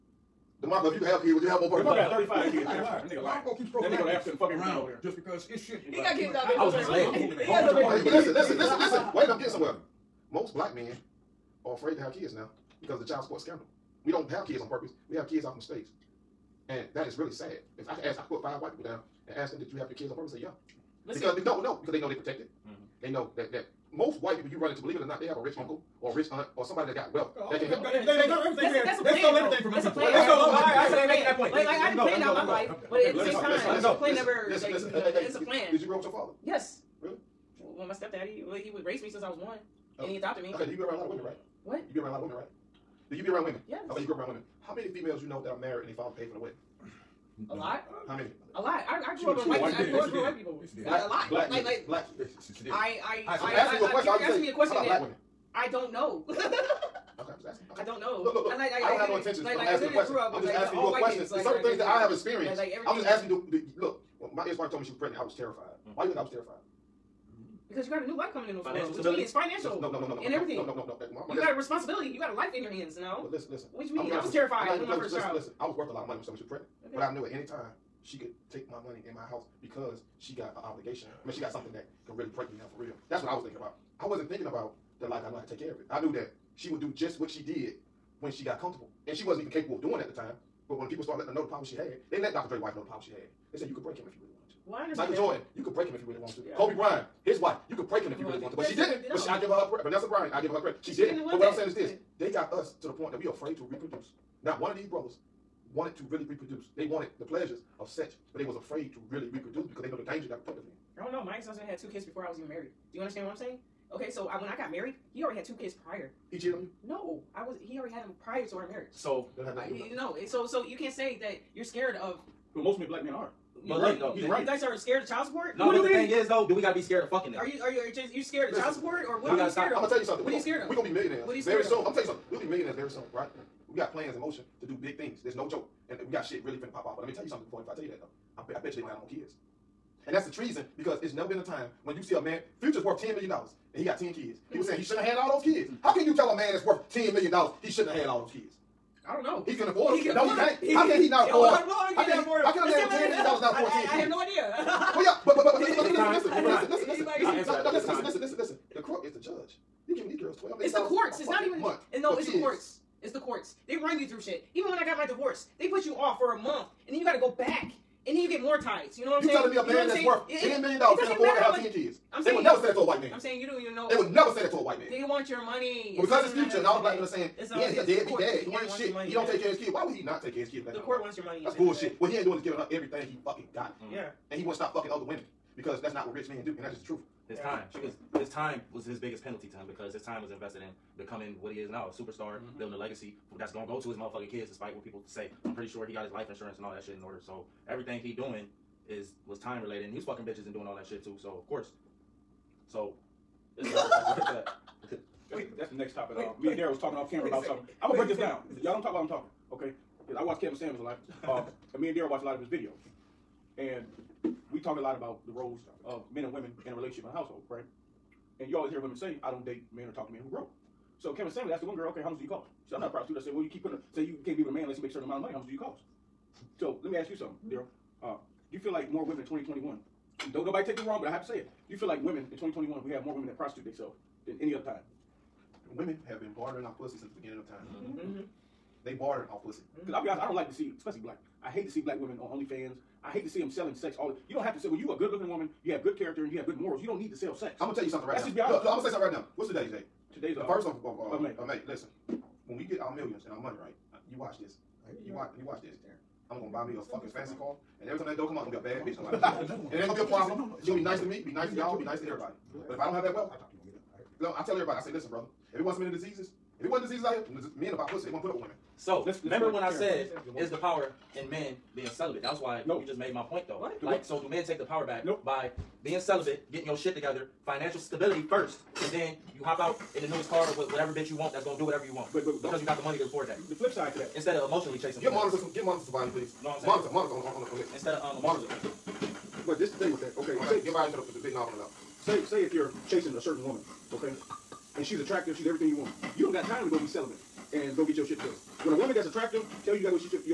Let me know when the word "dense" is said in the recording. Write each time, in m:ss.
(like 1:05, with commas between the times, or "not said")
not said.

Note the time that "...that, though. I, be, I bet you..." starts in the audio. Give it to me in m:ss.
2:17.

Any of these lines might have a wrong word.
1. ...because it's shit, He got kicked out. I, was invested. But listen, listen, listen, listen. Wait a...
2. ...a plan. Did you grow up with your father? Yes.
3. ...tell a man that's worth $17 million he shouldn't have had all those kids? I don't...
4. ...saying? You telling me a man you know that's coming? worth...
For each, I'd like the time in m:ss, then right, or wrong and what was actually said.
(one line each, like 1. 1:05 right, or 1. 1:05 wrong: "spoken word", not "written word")
1. 0:05 wrong: "misled", not "invested"
2. 0:35 right
3. 2:26 wrong: "10", not "17"
4. 2:49 wrong: "saying", not "coming".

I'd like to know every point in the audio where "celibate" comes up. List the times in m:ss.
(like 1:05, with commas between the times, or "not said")
4:31, 4:35, 4:56.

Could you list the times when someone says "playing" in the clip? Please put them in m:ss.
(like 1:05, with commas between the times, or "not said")
not said.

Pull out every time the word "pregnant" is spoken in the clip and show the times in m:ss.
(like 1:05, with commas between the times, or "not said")
1:04, 1:16.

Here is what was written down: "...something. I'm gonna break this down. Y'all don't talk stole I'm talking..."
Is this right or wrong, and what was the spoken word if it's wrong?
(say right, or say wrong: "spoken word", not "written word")
wrong: "while", not "stole".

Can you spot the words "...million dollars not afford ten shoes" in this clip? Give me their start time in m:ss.
2:33.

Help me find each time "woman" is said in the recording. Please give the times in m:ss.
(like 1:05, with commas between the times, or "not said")
4:05, 4:53, 4:58.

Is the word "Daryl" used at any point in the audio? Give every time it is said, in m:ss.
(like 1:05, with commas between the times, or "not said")
3:26, 3:31, 3:47.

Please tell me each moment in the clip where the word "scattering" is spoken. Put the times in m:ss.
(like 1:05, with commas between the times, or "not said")
not said.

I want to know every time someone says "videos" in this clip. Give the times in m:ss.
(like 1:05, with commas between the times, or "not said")
3:32.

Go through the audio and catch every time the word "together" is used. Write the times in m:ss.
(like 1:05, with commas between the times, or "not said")
4:36, 4:58.